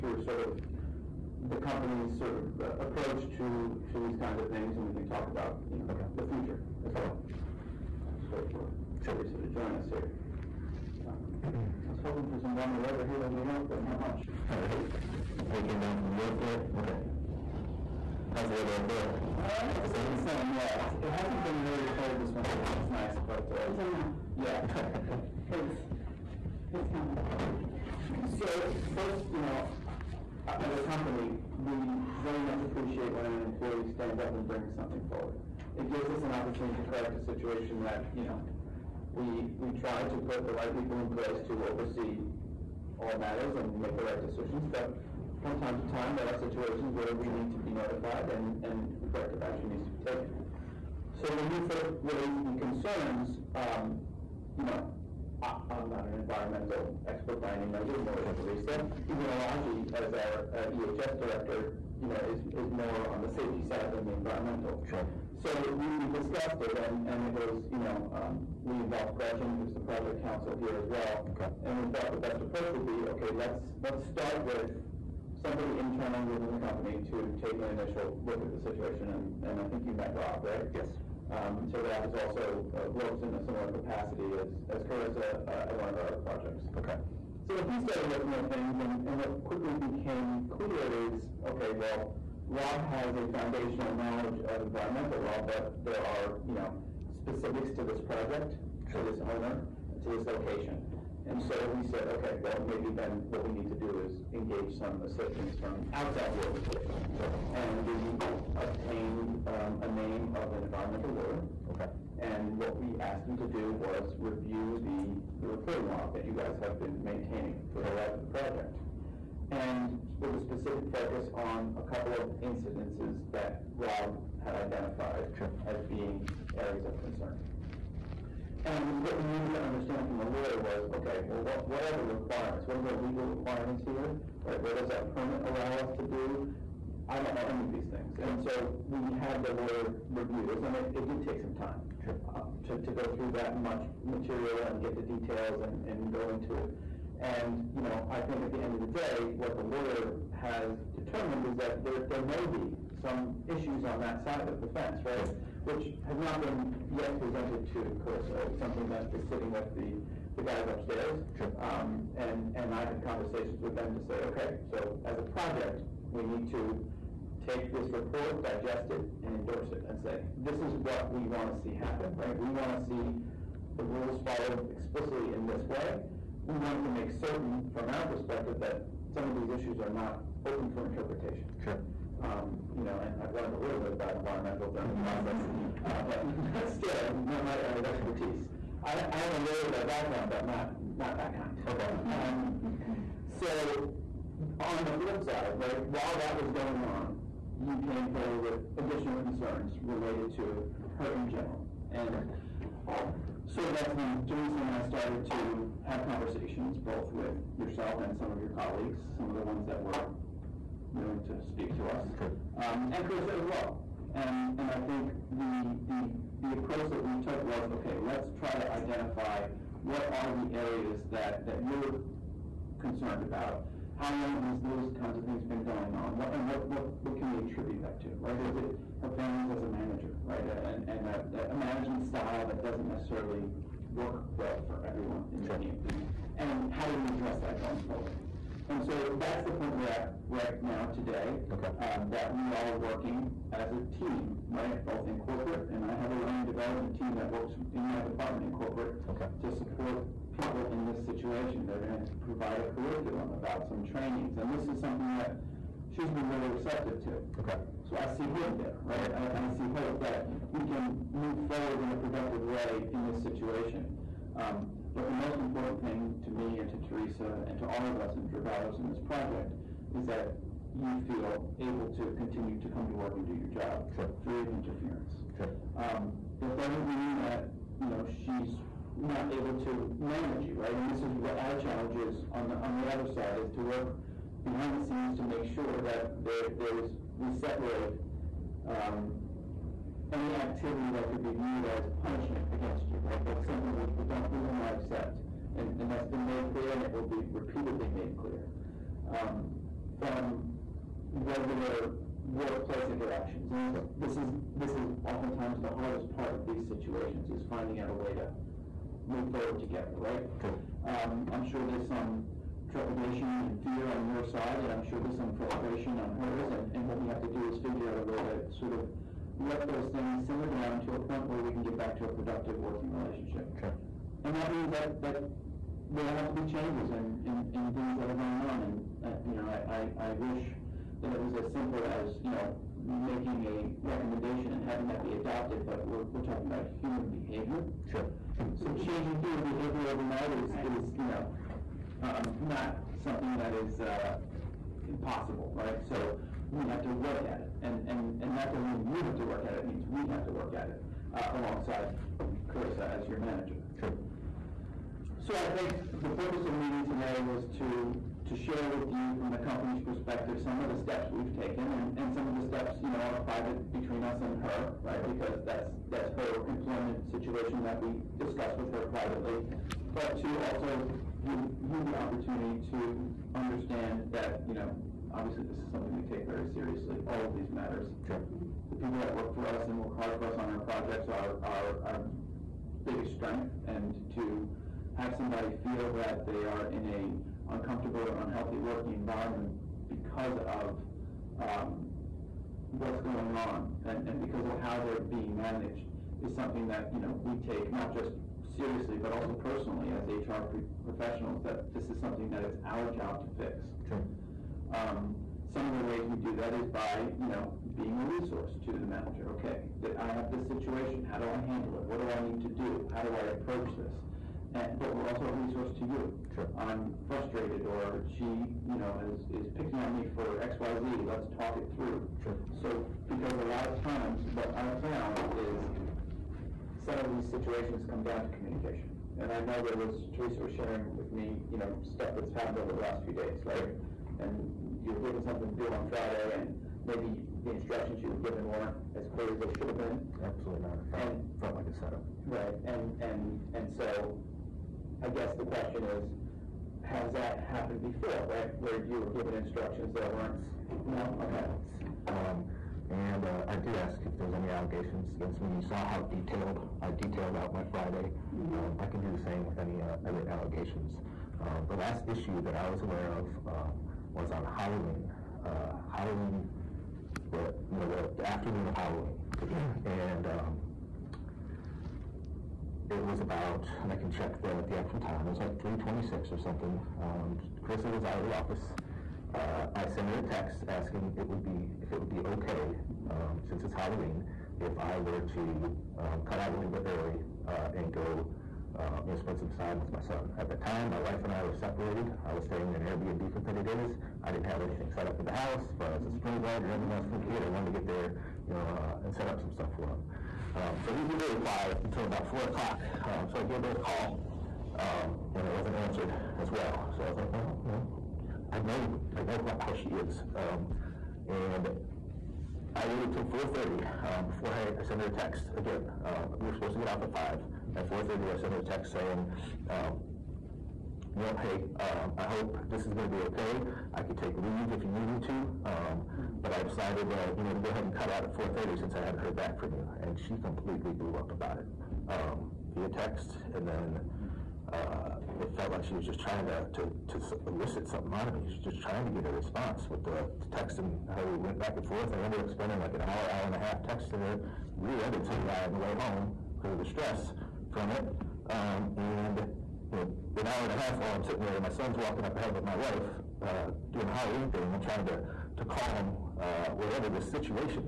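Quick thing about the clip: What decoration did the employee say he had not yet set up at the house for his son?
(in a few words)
strobe light.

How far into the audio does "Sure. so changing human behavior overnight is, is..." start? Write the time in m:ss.
5:37.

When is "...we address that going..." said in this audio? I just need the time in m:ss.
3:56.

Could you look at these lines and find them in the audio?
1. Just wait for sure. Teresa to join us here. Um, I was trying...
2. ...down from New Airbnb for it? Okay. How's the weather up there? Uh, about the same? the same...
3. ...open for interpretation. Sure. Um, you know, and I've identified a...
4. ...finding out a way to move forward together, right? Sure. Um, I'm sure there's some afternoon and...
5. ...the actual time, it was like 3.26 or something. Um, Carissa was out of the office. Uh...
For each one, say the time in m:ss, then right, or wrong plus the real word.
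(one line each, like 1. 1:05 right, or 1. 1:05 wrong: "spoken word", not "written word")
1. 0:08 wrong: "hoping", not "trying"
2. 0:15 wrong: "York", not "Airbnb"
3. 3:00 wrong: "learned", not "identified"
4. 5:07 wrong: "trepidation", not "afternoon"
5. 7:54 right.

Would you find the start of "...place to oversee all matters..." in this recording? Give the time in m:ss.
0:41.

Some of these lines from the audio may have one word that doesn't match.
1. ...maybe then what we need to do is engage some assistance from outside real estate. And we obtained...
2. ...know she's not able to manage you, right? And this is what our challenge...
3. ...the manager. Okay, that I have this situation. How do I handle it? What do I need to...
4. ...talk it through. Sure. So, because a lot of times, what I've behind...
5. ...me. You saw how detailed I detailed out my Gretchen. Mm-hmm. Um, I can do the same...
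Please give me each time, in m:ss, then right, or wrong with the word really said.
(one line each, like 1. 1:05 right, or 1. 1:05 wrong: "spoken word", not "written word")
1. 1:42 right
2. 4:37 right
3. 6:48 right
4. 7:01 wrong: "found", not "behind"
5. 7:35 wrong: "Friday", not "Gretchen".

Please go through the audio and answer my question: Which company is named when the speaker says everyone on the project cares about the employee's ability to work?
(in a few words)
Dragados.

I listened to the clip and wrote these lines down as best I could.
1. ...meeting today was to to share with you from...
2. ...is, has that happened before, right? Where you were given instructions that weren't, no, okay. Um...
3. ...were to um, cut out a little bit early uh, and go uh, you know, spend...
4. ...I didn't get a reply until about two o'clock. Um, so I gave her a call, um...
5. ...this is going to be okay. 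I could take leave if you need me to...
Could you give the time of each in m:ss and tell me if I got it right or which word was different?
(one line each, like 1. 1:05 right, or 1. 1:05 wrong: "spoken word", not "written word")
1. 5:56 right
2. 7:25 right
3. 8:04 right
4. 8:20 wrong: "four", not "two"
5. 8:42 right.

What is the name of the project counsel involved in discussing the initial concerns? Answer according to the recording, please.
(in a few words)
Gretchen.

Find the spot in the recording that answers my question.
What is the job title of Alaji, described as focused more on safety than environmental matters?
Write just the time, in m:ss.
1:00.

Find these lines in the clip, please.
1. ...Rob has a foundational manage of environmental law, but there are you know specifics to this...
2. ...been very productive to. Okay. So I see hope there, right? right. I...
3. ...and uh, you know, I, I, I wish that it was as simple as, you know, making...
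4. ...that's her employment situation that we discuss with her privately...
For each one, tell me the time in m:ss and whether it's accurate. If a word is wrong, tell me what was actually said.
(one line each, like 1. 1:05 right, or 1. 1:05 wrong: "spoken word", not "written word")
1. 1:32 wrong: "knowledge", not "manage"
2. 4:16 wrong: "receptive", not "productive"
3. 5:28 right
4. 6:05 right.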